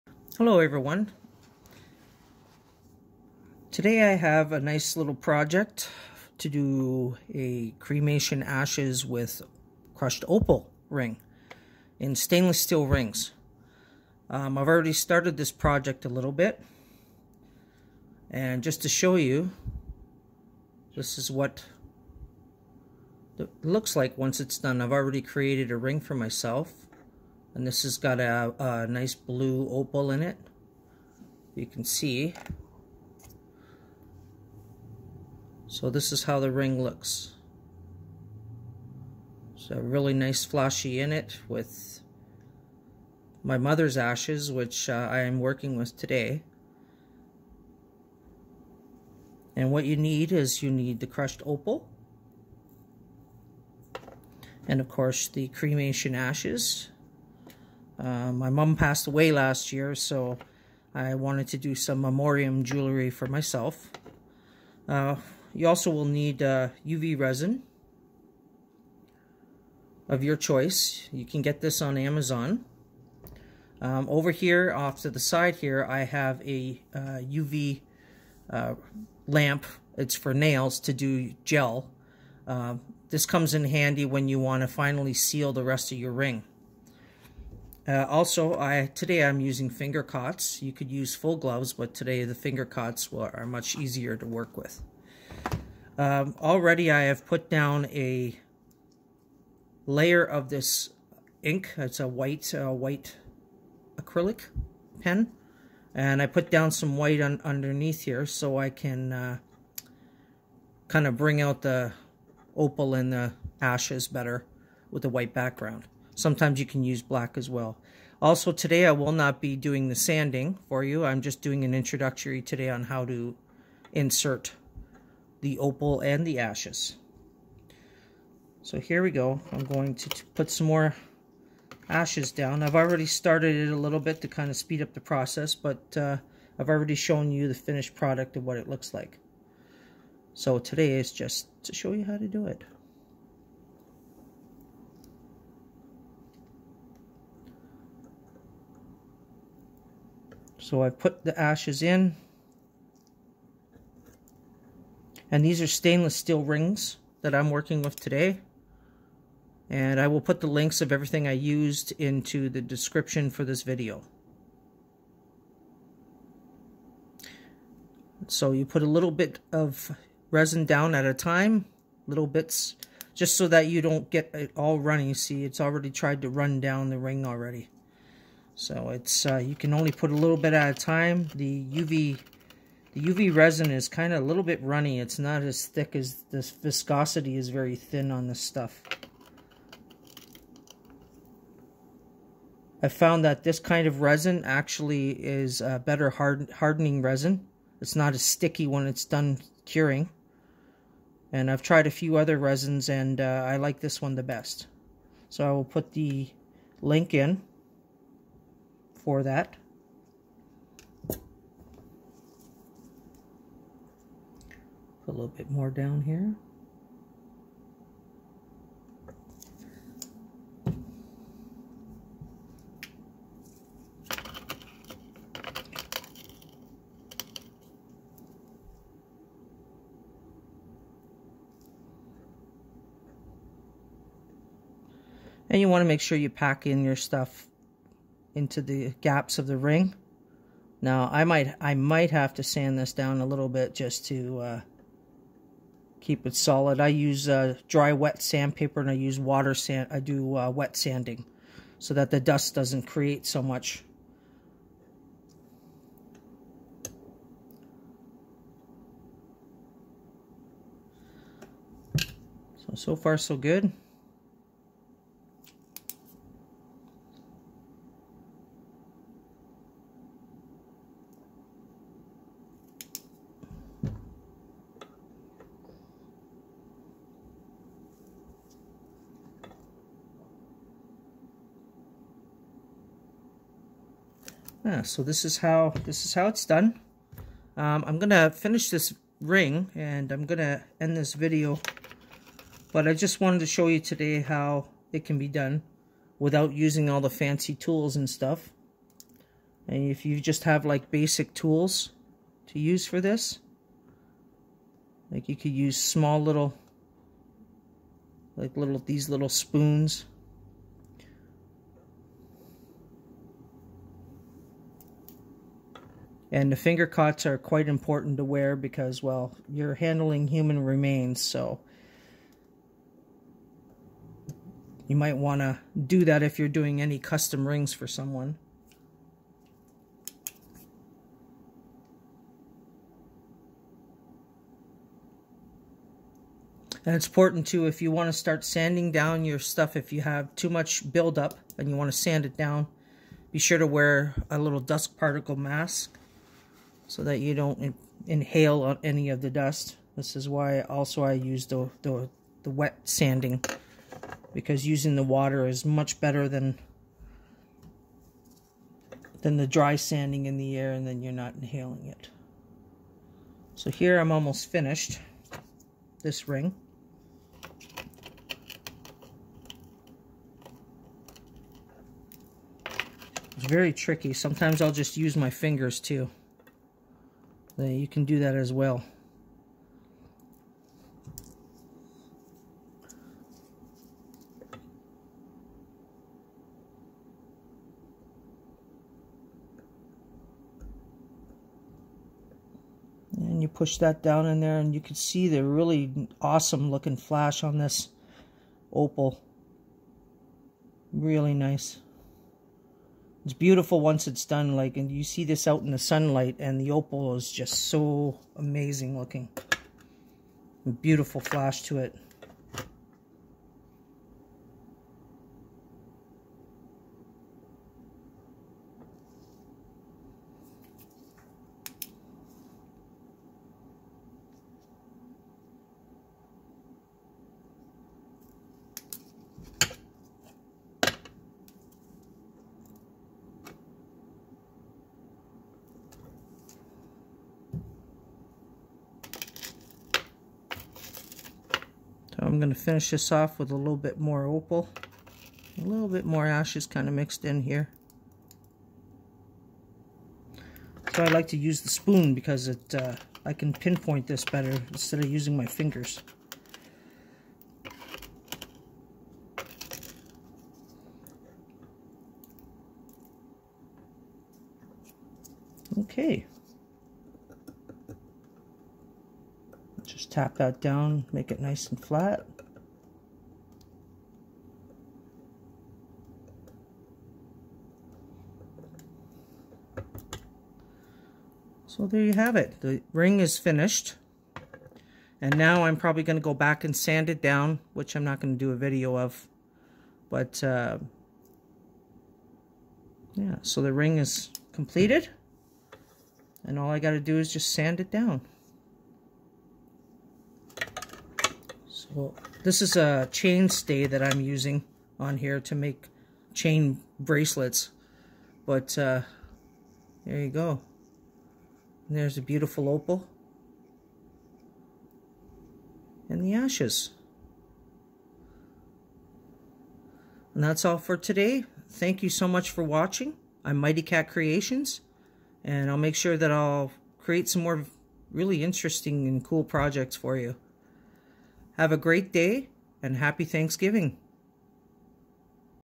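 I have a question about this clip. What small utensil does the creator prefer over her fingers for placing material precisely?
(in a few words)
spoon.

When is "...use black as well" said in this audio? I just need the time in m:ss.
1:56.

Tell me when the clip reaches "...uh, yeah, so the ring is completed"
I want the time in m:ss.
8:10.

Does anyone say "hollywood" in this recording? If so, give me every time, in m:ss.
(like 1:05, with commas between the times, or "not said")
not said.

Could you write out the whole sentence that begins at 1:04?
Uh, you also will need uh, UV resin of your choice.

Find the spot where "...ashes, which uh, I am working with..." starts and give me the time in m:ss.
0:43.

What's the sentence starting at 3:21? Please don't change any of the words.
And I've tried a few other resins and uh, I like this one the best.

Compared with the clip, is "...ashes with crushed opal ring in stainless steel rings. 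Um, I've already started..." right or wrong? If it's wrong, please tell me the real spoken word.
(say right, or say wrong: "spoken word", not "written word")
right.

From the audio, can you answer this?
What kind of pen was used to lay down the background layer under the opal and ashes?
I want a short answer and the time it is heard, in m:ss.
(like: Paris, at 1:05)
white acrylic pen, at 1:42.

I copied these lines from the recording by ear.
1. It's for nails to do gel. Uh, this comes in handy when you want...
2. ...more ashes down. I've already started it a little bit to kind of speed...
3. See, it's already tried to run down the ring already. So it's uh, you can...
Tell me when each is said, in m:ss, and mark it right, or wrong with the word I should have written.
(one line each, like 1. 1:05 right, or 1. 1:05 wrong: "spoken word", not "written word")
1. 1:19 right
2. 2:10 right
3. 2:55 right.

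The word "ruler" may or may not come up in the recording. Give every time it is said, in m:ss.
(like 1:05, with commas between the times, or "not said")
not said.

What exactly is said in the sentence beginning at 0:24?
I've already created a ring for myself and this has got a, a nice blue opal in it.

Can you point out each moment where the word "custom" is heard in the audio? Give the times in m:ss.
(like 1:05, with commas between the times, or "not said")
5:26.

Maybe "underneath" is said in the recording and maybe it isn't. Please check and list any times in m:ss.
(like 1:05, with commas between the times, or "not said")
1:47.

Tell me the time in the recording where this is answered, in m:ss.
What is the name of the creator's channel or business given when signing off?
8:43.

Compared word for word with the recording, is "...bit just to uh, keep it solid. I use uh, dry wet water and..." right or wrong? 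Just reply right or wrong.
wrong.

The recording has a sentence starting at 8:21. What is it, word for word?
Well, this is a chain stay that I'm using on here to make chain bracelets.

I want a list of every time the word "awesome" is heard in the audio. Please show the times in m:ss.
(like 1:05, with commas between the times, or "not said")
6:36.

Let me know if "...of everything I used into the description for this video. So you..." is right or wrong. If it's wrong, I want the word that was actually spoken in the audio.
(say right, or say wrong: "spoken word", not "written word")
right.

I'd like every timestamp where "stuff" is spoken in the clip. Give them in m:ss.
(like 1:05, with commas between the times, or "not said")
3:08, 3:56, 4:58, 5:39.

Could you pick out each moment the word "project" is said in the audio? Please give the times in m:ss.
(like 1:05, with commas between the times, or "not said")
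0:05, 0:15, 8:49.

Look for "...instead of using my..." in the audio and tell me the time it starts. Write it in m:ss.
7:34.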